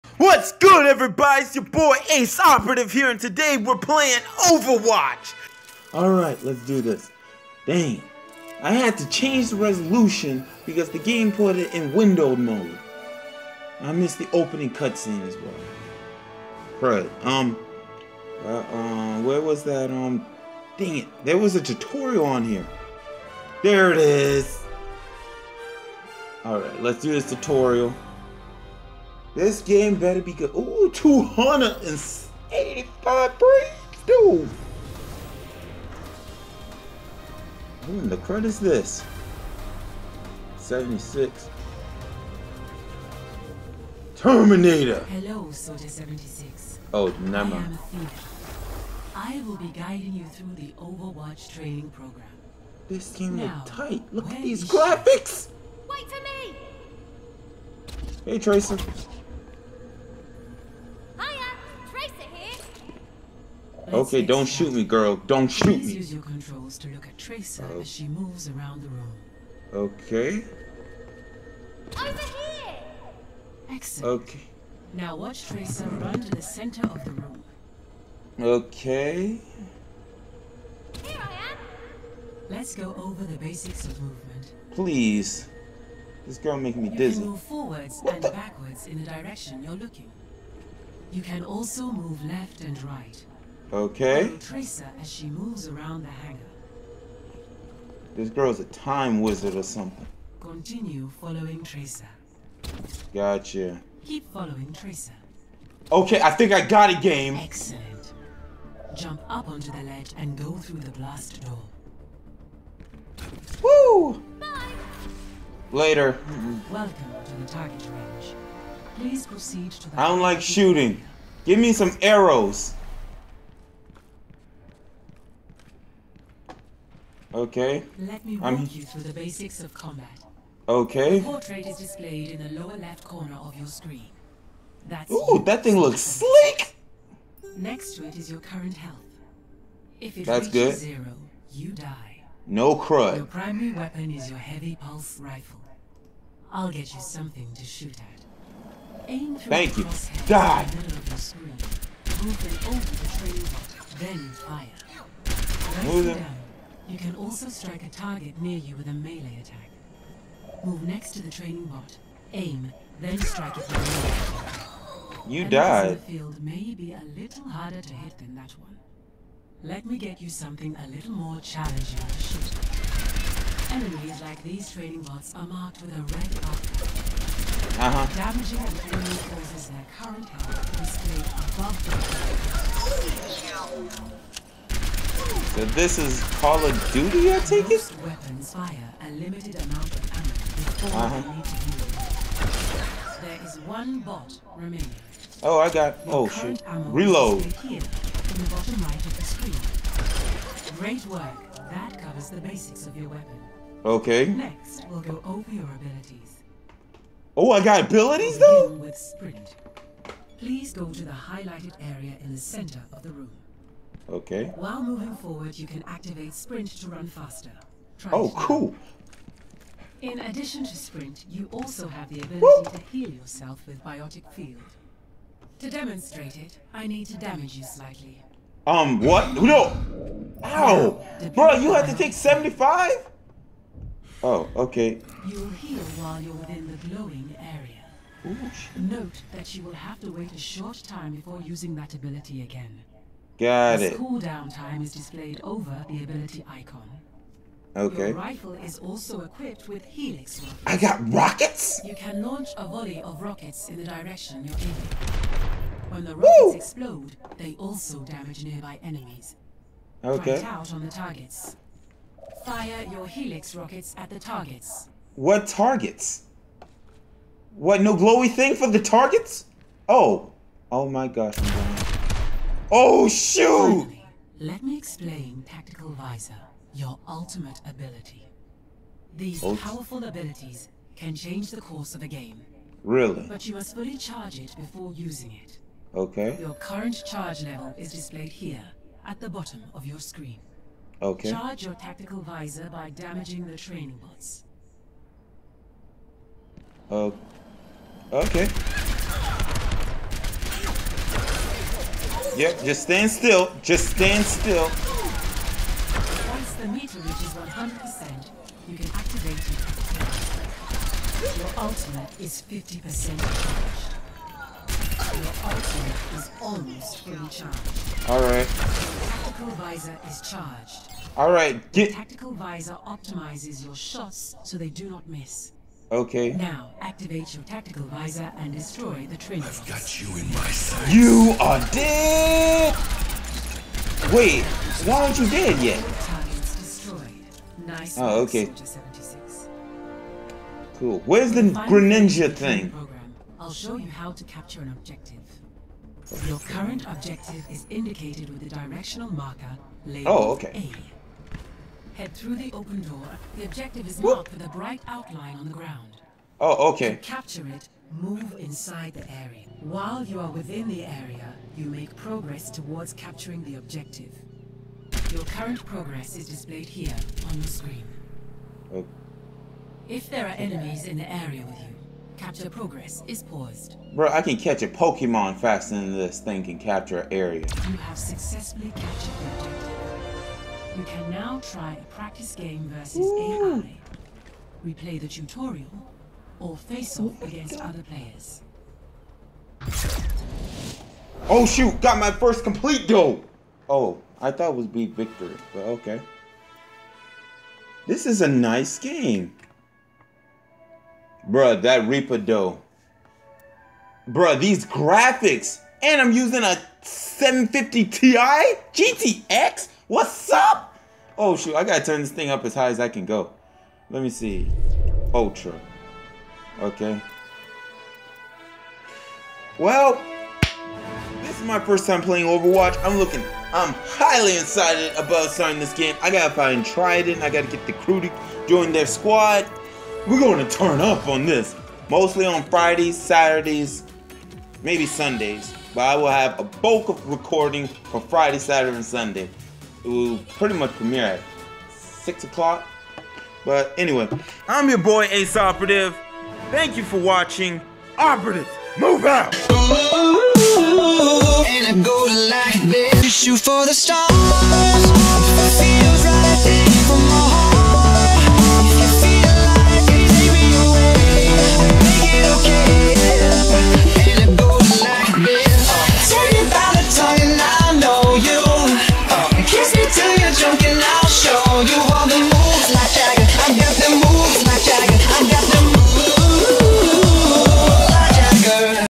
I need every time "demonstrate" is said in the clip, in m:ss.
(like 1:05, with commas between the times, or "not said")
3:45.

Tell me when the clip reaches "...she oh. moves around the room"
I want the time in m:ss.
1:07.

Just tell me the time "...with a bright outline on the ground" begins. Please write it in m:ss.
5:54.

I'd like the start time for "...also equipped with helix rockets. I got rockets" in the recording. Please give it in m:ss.
4:08.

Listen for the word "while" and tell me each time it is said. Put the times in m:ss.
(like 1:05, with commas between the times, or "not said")
3:34, 3:56, 5:59.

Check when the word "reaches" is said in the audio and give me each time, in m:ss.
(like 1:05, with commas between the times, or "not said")
2:20, 5:06.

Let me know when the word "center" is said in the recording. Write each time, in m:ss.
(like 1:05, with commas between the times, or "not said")
1:16, 3:32.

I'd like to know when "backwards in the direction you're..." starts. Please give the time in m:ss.
1:28.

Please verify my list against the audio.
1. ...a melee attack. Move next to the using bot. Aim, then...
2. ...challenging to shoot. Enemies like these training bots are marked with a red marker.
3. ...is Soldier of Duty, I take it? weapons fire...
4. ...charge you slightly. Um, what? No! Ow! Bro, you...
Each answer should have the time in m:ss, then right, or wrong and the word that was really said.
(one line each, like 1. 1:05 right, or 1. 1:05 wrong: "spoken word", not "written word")
1. 2:38 wrong: "training", not "using"
2. 2:51 right
3. 3:05 wrong: "Call", not "Soldier"
4. 3:47 wrong: "damage", not "charge".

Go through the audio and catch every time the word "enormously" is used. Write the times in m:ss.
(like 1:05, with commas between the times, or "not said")
not said.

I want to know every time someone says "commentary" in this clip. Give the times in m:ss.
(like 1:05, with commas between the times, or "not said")
not said.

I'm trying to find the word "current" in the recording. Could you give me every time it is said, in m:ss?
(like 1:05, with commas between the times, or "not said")
2:18, 2:59, 4:46, 5:46, 6:05.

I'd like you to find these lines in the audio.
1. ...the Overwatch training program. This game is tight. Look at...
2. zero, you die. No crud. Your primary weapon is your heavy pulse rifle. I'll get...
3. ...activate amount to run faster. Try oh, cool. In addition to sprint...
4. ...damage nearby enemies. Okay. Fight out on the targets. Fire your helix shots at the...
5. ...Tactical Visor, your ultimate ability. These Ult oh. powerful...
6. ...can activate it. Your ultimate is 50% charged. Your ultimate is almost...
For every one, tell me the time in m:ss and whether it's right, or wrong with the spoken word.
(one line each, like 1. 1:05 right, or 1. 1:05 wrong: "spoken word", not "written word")
1. 0:50 right
2. 2:20 right
3. 3:35 wrong: "sprint", not "amount"
4. 4:18 wrong: "rockets", not "shots"
5. 4:35 right
6. 5:08 right.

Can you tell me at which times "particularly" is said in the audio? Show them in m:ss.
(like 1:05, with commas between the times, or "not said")
not said.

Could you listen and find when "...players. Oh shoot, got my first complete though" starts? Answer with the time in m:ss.
6:27.